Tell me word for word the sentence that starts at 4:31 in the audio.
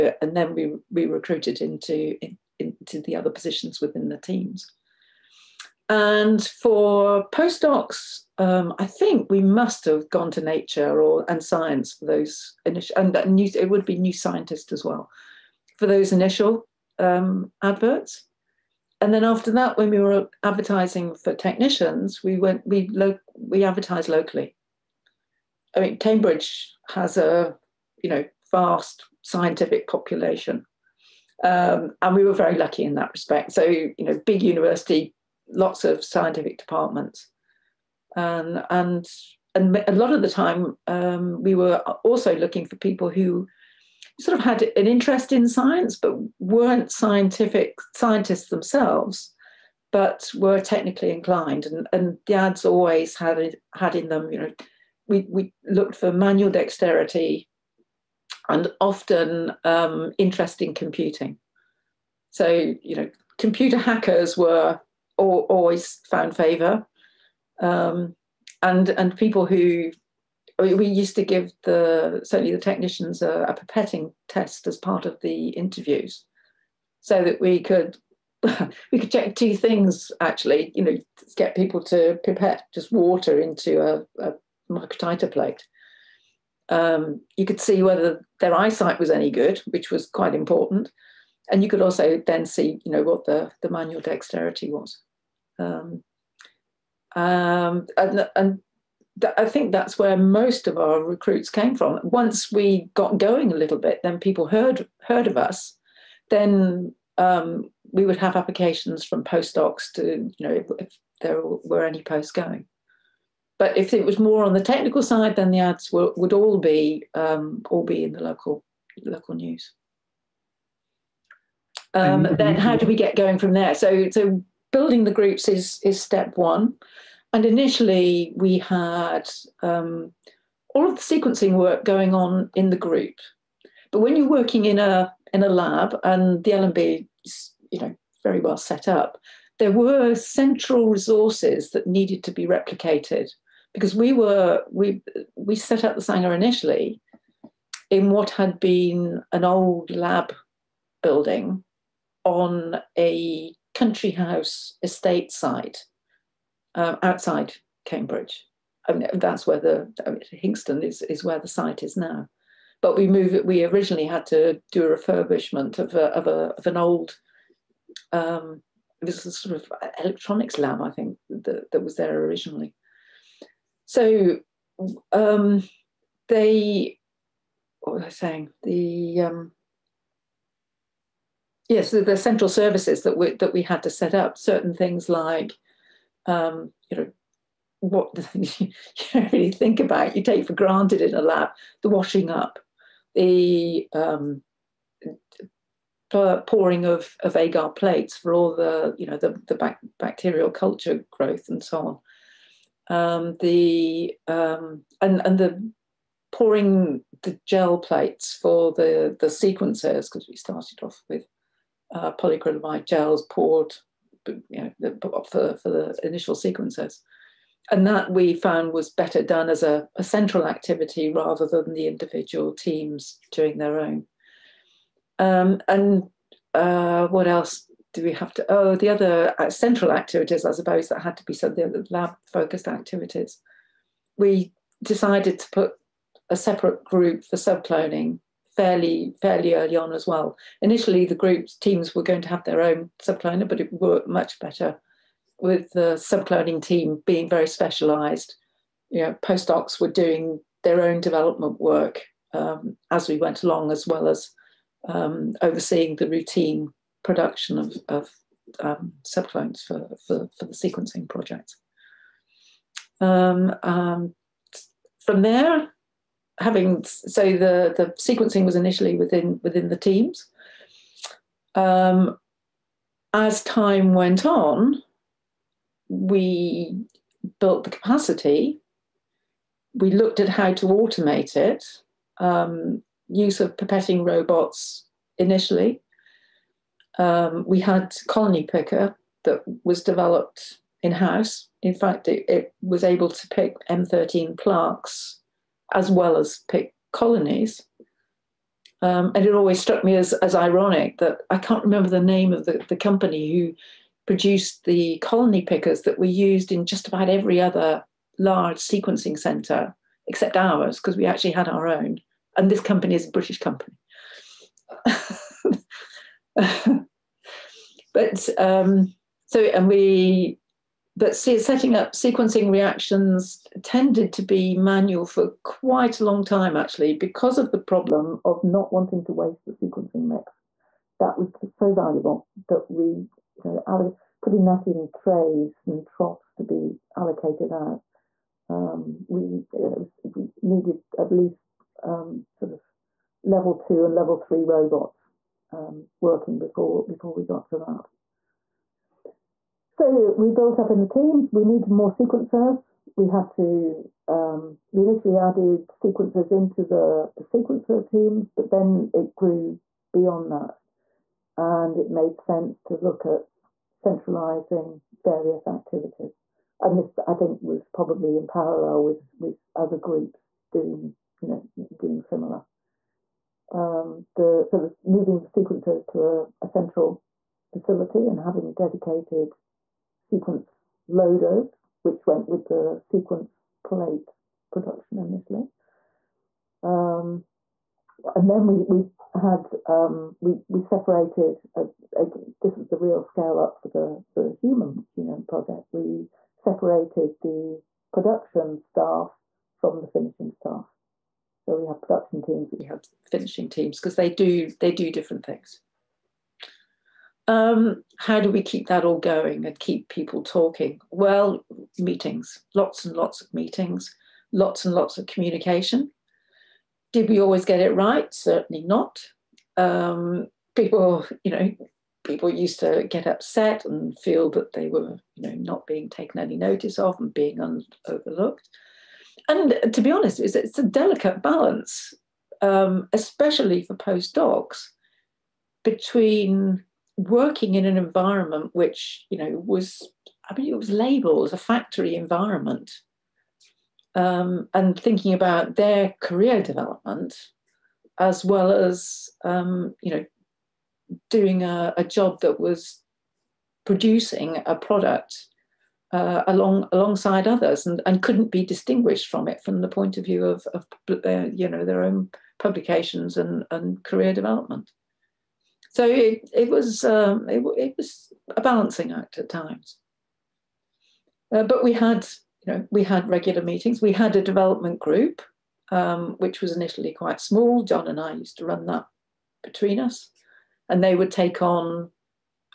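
Um, as time went on, we built the capacity.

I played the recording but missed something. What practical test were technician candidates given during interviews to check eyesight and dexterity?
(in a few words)
A pipetting test.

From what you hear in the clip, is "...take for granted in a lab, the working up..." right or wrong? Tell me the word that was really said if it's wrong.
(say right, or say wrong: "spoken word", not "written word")
wrong: "washing", not "working".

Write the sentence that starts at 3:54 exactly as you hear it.
We decided to put a separate group for subcloning fairly fairly early on as well.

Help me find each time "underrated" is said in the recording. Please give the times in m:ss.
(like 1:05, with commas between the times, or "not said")
not said.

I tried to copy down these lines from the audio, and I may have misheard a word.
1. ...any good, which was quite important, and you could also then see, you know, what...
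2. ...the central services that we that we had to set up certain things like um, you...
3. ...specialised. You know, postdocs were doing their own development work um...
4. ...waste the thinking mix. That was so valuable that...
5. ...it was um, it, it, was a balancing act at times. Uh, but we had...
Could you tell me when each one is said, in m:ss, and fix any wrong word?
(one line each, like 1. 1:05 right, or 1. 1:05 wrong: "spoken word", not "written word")
1. 1:29 right
2. 3:02 right
3. 4:07 right
4. 5:29 wrong: "sequencing", not "thinking"
5. 7:46 right.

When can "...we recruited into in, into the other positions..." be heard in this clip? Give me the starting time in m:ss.
0:00.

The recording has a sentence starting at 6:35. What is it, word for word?
We separated the production staff from the finishing staff.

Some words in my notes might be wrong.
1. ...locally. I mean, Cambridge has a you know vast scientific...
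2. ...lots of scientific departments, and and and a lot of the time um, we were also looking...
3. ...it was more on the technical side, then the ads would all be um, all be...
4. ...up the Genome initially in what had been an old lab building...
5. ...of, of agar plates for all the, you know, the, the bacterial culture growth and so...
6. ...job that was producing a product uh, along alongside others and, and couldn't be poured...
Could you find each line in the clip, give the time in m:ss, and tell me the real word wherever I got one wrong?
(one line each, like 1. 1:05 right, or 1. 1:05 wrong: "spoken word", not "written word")
1. 0:24 right
2. 0:35 right
3. 1:53 right
4. 2:25 wrong: "Sanger", not "Genome"
5. 3:16 right
6. 7:31 wrong: "distinguished", not "poured".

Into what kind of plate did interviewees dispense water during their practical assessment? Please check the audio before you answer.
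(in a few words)
Microtiter plate.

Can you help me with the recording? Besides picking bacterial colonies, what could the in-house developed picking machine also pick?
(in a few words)
M13 plaques.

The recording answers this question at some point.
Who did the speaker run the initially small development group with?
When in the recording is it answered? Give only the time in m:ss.
7:57.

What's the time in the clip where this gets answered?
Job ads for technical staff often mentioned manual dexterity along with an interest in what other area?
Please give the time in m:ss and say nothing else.
1:00.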